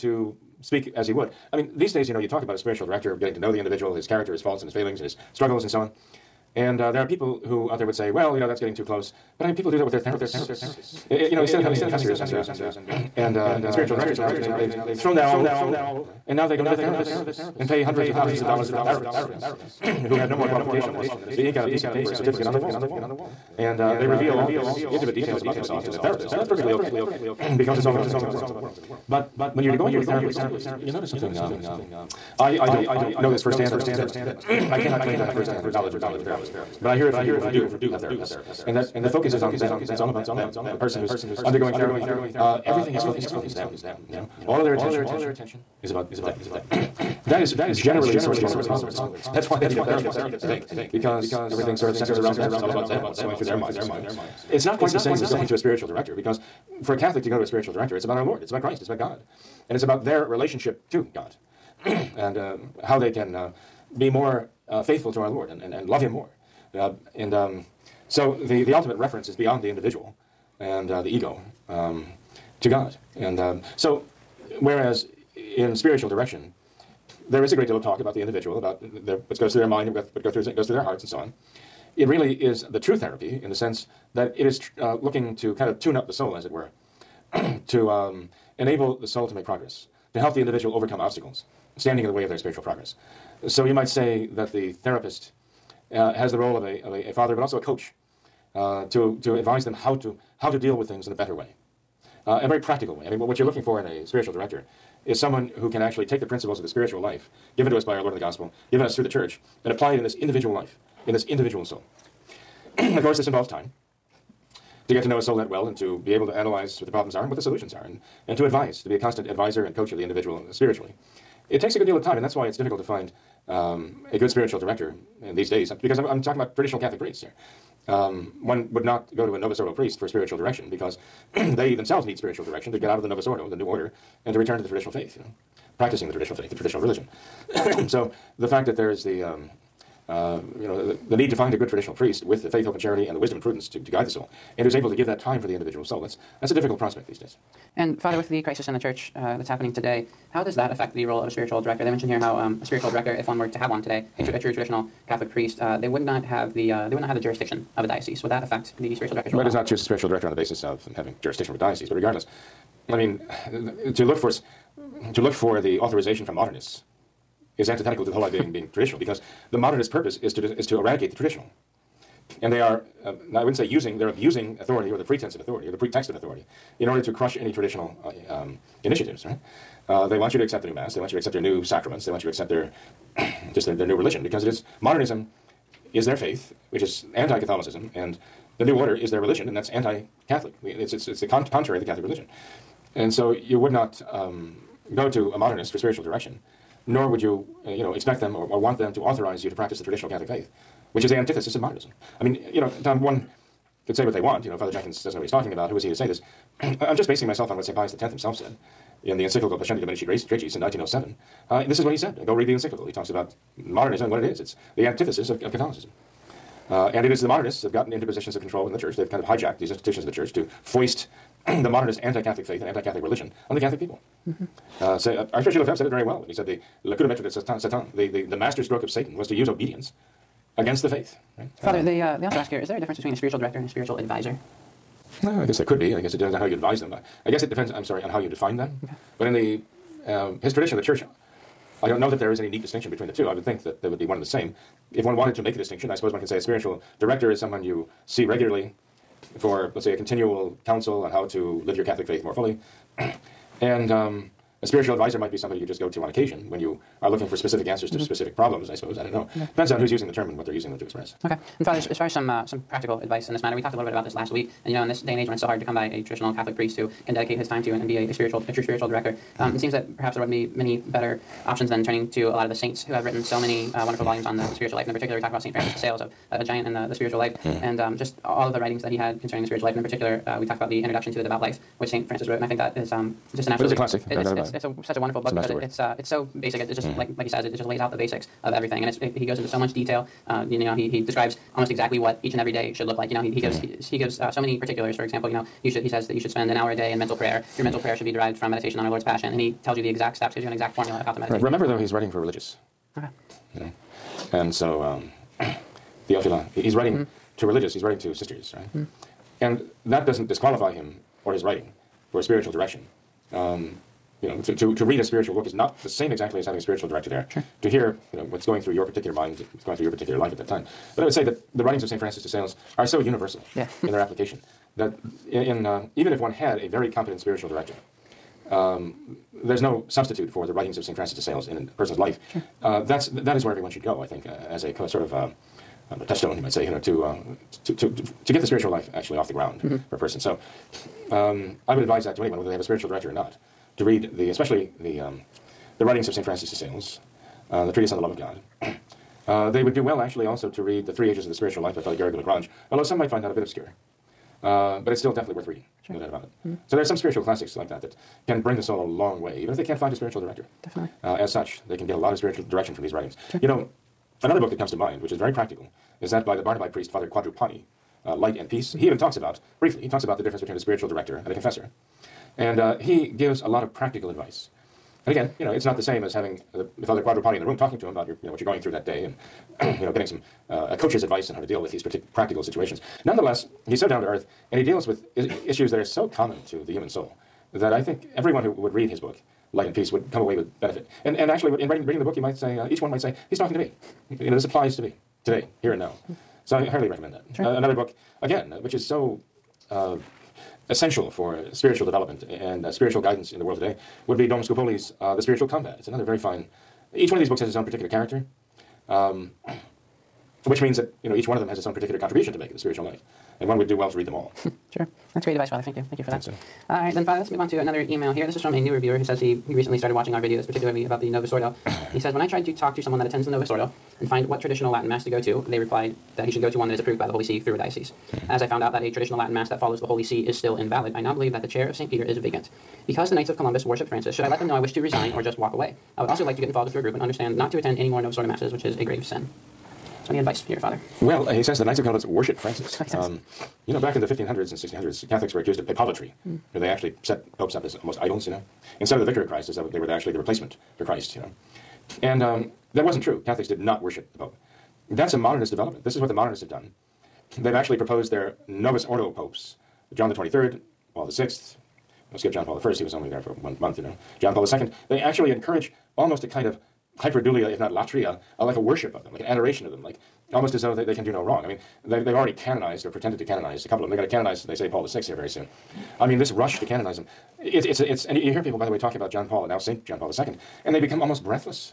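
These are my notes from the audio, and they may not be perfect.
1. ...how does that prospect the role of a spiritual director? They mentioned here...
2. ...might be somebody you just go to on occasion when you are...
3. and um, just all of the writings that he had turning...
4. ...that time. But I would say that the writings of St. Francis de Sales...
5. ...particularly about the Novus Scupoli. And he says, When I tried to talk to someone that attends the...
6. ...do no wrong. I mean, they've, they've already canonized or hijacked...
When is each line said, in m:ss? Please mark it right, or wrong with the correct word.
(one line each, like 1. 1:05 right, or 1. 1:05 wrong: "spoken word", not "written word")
1. 2:30 wrong: "affect", not "prospect"
2. 4:15 right
3. 4:37 wrong: "concerning", not "turning"
4. 5:20 right
5. 7:00 wrong: "Ordo", not "Scupoli"
6. 7:51 wrong: "pretended", not "hijacked".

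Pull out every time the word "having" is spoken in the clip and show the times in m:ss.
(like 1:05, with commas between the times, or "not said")
0:11, 2:40, 5:16, 6:16.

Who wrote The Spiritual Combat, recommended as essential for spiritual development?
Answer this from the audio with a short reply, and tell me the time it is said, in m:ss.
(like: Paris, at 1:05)
Dom Scupoli, at 6:44.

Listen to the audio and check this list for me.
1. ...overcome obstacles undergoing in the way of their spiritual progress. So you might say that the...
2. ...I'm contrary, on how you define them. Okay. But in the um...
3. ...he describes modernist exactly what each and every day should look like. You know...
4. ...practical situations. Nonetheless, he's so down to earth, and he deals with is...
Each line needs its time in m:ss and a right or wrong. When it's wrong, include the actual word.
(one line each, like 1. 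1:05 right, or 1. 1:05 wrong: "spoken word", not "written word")
1. 1:30 wrong: "standing", not "undergoing"
2. 3:57 wrong: "sorry", not "contrary"
3. 4:50 wrong: "almost", not "modernist"
4. 6:22 right.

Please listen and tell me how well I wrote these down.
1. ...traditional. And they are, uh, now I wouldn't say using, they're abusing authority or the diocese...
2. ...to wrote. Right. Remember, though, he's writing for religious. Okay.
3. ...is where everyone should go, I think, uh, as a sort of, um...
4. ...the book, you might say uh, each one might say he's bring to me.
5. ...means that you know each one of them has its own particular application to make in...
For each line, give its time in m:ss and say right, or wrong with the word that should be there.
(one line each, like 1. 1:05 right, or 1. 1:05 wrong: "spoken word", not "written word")
1. 2:51 wrong: "pretense", not "diocese"
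2. 5:01 wrong: "meditate", not "wrote"
3. 5:33 right
4. 6:31 wrong: "talking", not "bring"
5. 6:50 wrong: "contribution", not "application".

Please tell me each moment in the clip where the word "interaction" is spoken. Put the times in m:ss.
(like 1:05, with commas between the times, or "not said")
not said.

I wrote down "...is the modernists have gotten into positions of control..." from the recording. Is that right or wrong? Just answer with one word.
right.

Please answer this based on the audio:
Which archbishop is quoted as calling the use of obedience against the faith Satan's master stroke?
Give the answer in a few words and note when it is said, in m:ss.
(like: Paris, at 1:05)
Archbishop Lefebvre, at 3:45.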